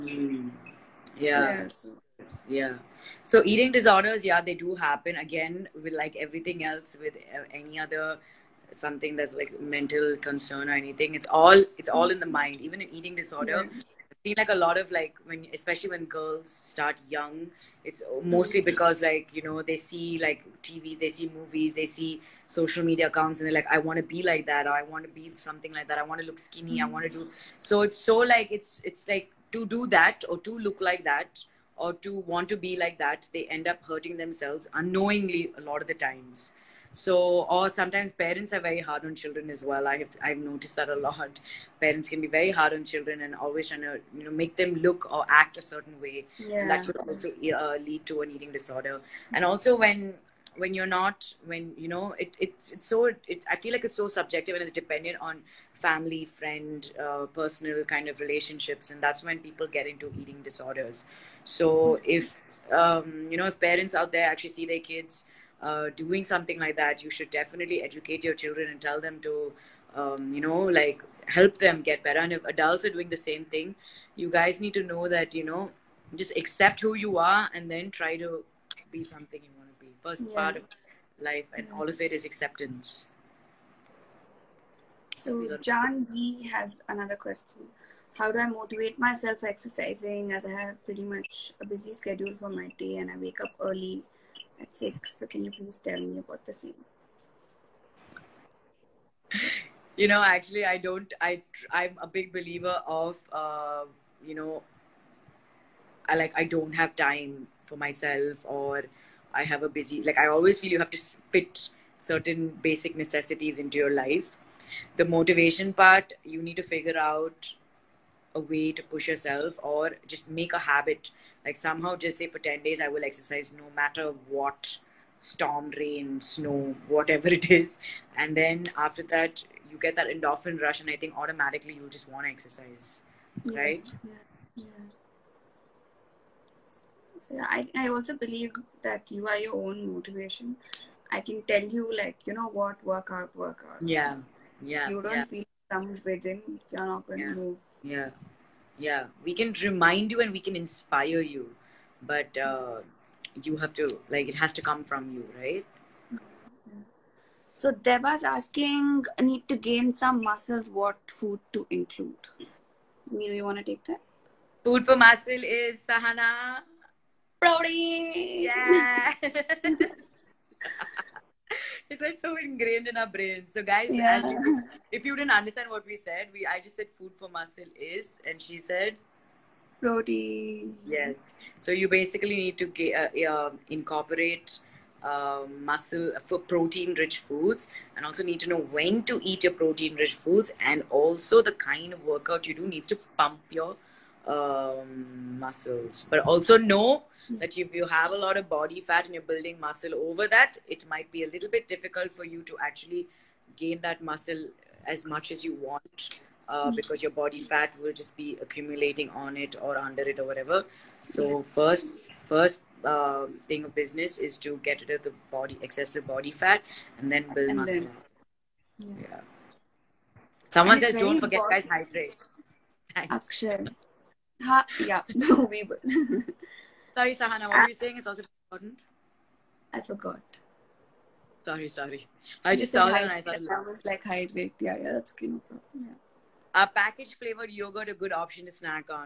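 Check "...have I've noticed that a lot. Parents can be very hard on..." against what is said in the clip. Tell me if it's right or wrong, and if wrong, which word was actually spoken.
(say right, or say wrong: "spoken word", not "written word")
right.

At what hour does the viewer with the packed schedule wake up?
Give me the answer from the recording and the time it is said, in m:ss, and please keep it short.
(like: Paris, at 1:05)
6, at 1:34.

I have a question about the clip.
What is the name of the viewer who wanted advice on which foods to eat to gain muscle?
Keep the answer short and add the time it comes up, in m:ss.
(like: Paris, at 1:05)
Deva, at 2:37.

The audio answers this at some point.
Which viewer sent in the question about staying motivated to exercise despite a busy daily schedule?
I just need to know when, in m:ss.
1:25.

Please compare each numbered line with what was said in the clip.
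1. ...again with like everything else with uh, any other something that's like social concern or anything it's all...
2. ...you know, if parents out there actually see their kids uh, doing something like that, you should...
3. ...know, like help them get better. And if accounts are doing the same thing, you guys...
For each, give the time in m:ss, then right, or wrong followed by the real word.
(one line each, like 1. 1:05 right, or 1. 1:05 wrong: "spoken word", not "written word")
1. 0:05 wrong: "mental", not "social"
2. 1:03 right
3. 1:10 wrong: "adults", not "accounts".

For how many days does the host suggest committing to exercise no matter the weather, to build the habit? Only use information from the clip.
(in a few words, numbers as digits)
10 days.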